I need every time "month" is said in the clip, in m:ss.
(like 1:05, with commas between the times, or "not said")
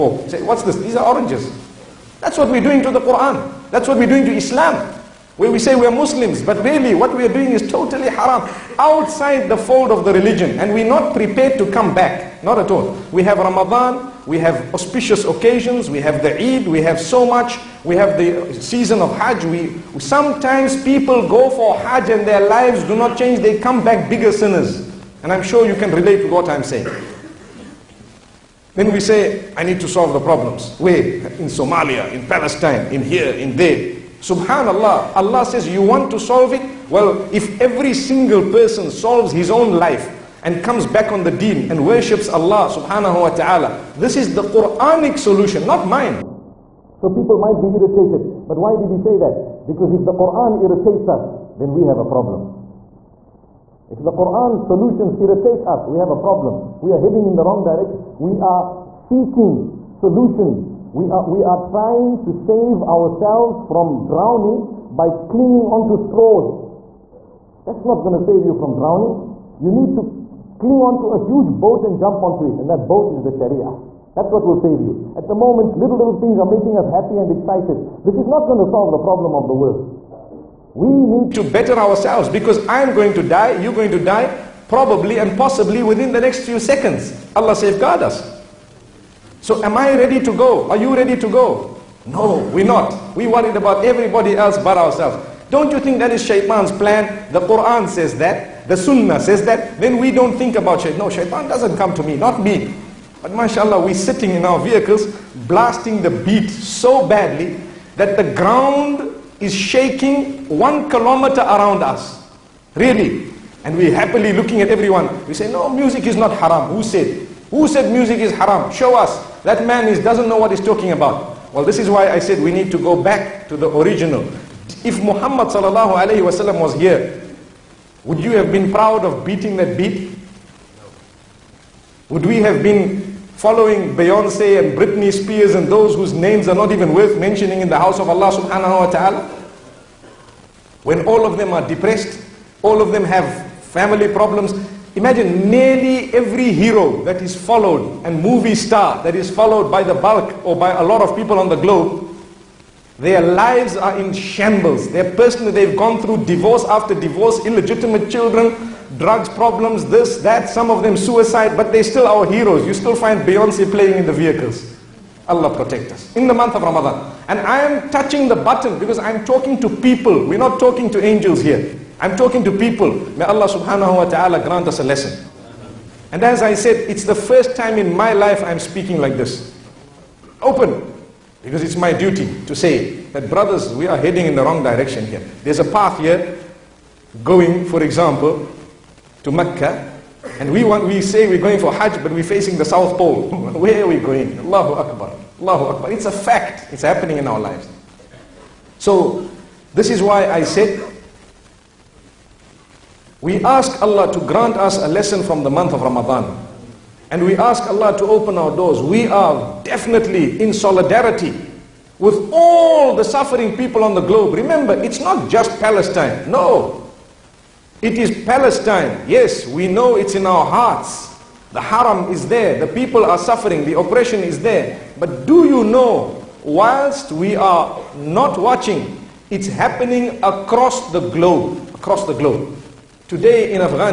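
2:46, 3:25.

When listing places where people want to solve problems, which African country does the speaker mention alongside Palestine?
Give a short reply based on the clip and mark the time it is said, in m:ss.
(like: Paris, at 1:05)
Somalia, at 0:31.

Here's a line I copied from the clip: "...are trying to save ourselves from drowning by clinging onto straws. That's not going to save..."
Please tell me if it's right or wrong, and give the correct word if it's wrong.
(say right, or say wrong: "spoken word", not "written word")
right.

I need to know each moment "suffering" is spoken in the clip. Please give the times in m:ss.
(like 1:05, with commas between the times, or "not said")
3:33, 3:43.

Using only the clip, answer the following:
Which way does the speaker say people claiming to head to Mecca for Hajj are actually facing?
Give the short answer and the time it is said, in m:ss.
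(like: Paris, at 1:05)
The South Pole, at 3:12.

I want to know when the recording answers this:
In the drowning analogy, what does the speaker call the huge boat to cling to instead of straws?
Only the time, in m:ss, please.
1:13.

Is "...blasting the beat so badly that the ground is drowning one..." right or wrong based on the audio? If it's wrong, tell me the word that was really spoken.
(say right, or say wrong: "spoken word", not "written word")
wrong: "shaking", not "drowning".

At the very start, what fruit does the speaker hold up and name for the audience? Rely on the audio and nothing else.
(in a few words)
Oranges.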